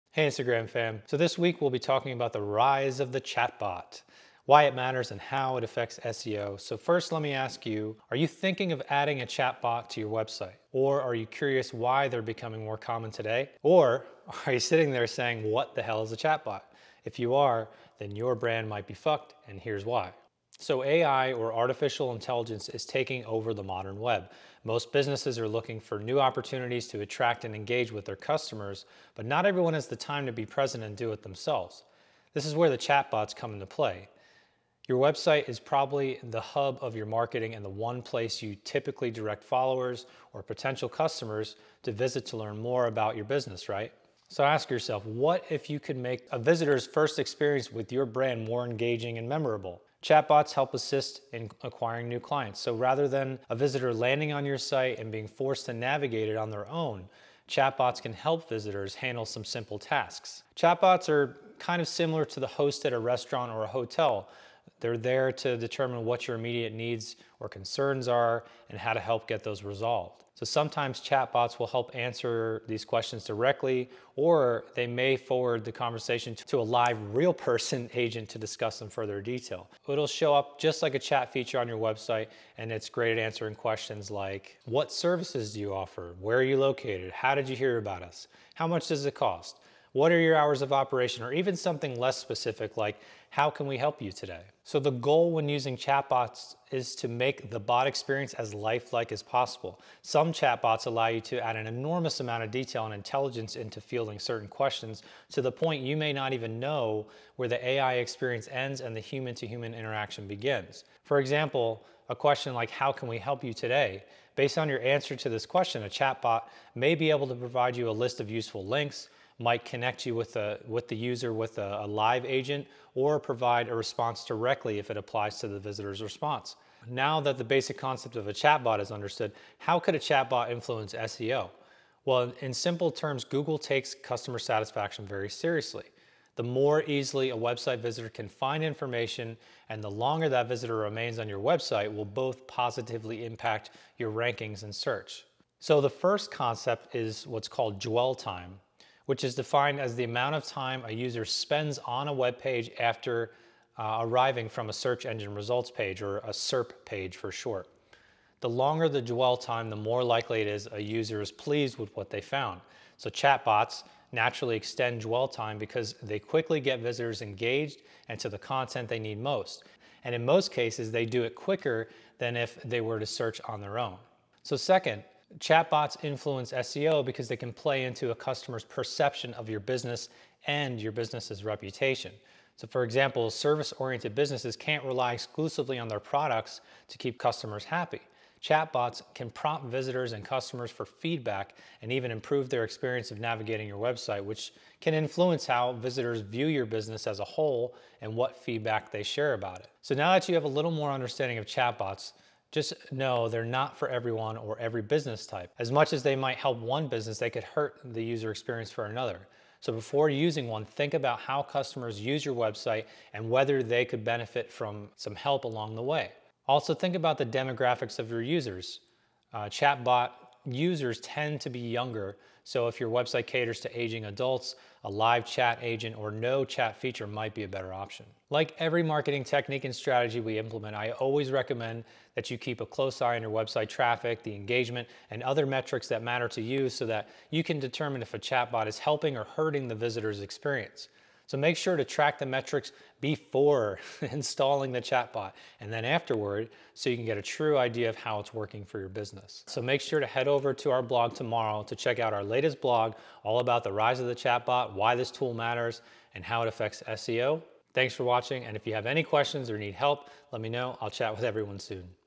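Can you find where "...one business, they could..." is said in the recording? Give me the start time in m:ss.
3:26.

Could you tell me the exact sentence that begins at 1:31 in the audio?
Or even something less specific like, how can we help you today?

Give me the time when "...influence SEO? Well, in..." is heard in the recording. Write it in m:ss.
2:10.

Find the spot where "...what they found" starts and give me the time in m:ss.
2:41.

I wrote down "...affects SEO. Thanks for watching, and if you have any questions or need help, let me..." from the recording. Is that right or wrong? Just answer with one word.
right.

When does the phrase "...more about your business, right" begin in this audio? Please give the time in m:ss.
0:42.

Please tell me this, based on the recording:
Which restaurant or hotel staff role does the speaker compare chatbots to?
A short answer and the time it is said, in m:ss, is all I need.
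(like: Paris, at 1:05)
host, at 1:02.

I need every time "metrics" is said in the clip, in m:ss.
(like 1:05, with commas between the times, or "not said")
3:55, 4:02.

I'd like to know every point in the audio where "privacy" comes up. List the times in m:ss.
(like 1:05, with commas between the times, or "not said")
not said.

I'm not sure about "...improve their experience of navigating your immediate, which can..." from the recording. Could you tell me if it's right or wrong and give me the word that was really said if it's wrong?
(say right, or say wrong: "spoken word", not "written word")
wrong: "website", not "immediate".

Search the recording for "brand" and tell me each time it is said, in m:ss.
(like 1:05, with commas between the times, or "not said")
0:18, 0:48.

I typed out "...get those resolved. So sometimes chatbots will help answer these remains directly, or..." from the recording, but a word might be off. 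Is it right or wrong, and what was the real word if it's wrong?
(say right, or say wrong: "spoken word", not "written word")
wrong: "questions", not "remains".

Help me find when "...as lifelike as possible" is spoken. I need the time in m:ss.
1:38.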